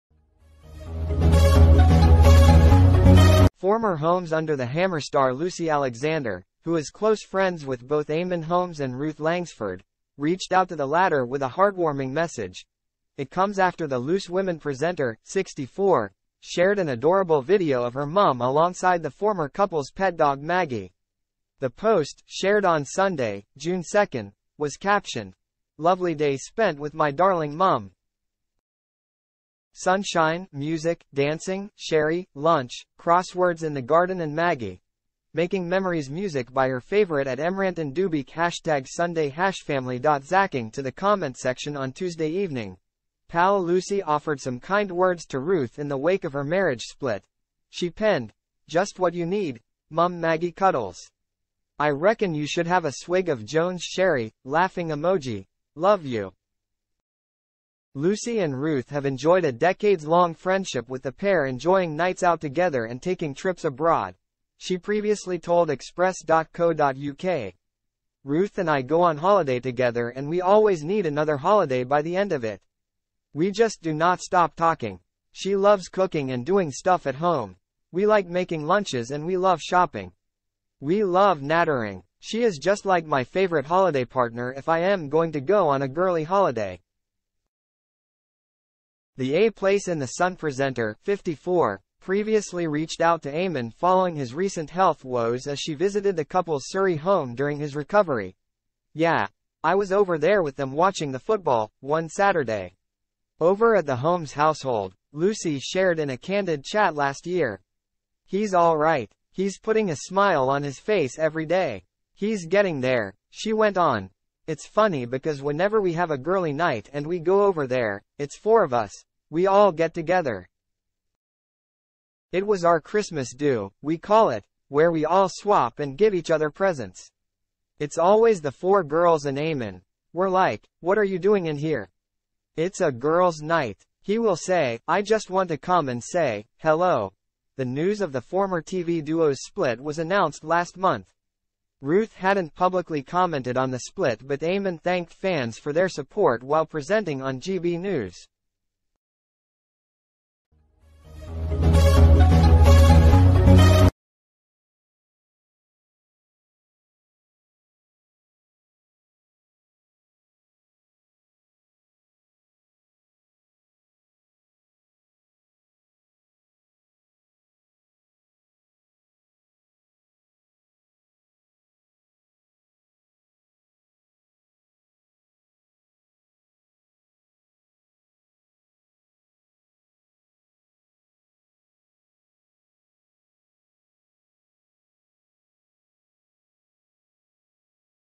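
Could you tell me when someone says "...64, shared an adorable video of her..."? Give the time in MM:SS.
00:15.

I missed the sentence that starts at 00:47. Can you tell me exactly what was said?
She penned, Just what you need, Mum Maggie Cuddles.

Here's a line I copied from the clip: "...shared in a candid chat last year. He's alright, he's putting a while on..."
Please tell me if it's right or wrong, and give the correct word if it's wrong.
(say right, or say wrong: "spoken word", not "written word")
wrong: "smile", not "while".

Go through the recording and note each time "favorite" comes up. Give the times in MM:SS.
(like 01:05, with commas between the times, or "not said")
00:36, 01:23.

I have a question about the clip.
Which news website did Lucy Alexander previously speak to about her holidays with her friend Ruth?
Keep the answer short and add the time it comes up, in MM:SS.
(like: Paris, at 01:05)
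Express.co.uk, at 01:05.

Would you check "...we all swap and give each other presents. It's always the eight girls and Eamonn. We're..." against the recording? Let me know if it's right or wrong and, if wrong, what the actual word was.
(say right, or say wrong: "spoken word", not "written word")
wrong: "four", not "eight".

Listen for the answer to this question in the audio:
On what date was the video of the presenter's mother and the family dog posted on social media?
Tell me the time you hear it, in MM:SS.
00:23.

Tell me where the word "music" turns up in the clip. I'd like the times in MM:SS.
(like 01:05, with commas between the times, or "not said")
00:30, 00:36.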